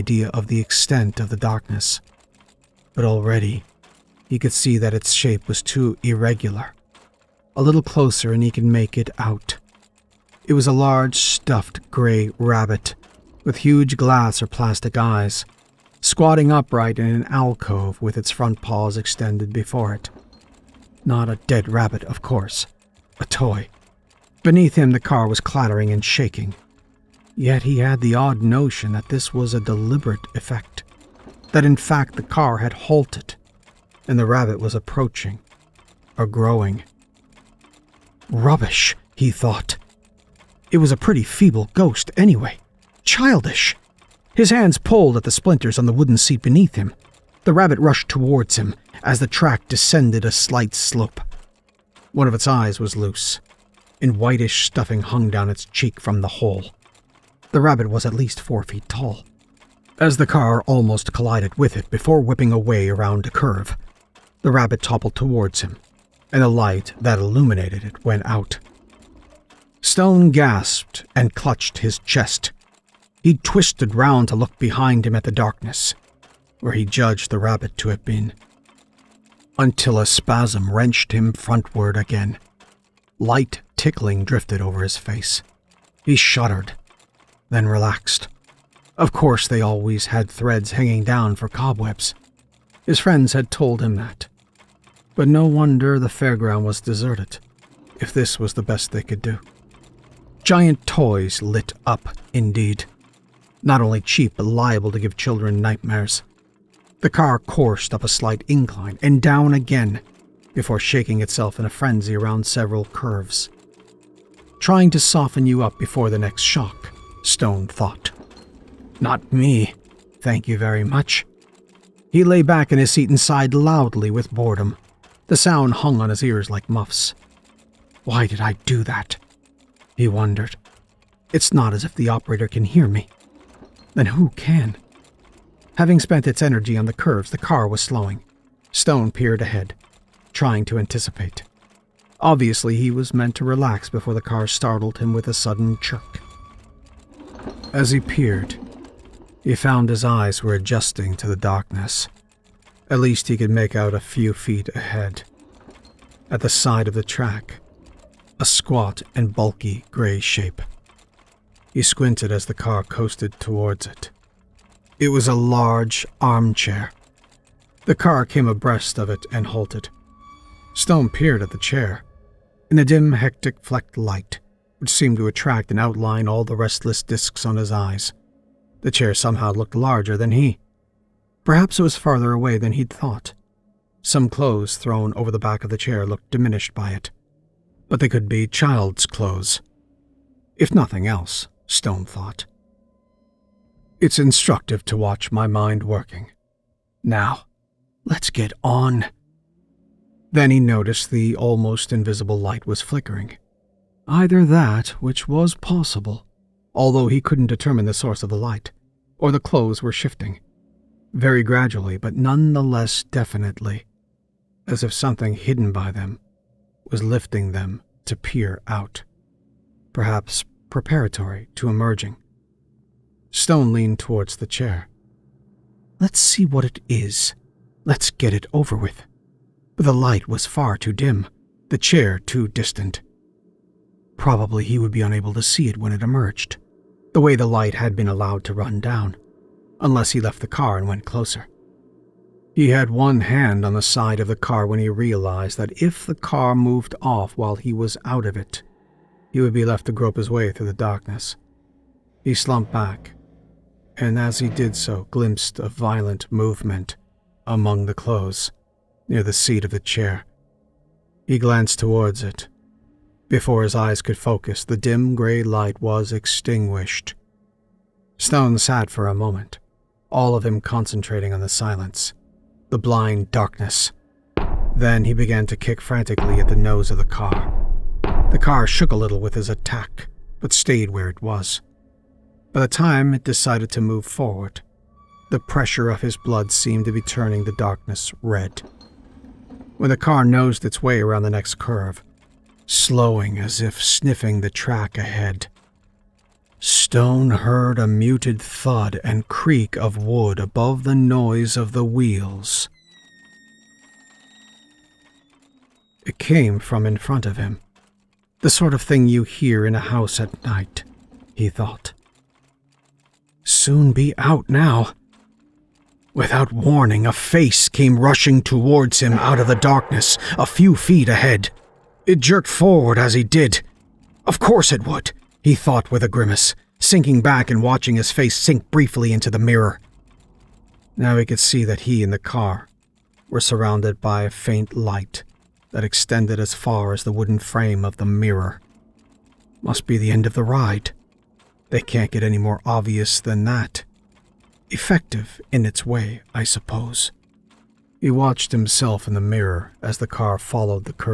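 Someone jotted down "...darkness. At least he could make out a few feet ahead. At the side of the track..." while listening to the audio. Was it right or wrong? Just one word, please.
right.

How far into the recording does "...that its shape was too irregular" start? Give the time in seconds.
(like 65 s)
4 s.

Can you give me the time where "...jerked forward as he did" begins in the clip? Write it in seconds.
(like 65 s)
322 s.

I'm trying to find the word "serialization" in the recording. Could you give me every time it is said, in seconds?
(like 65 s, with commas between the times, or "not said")
not said.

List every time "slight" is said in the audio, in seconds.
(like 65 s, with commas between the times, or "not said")
50 s, 108 s.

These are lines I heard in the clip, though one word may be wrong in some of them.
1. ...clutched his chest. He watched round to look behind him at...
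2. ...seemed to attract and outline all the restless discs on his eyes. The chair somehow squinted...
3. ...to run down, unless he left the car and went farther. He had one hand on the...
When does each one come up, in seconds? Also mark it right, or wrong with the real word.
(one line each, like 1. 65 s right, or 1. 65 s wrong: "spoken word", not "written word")
1. 71 s wrong: "twisted", not "watched"
2. 174 s wrong: "looked", not "squinted"
3. 238 s wrong: "closer", not "farther".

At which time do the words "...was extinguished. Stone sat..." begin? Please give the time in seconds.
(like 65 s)
265 s.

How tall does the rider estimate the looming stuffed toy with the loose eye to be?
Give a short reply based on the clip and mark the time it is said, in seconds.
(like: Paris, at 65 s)
4 feet, at 58 s.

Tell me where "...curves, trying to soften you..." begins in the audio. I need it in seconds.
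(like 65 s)
112 s.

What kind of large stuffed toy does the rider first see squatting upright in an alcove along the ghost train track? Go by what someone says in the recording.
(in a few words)
Gray rabbit.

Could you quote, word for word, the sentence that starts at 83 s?
Light tickling drifted over his face.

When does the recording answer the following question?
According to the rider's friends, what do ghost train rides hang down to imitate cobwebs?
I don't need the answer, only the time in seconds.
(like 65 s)
90 s.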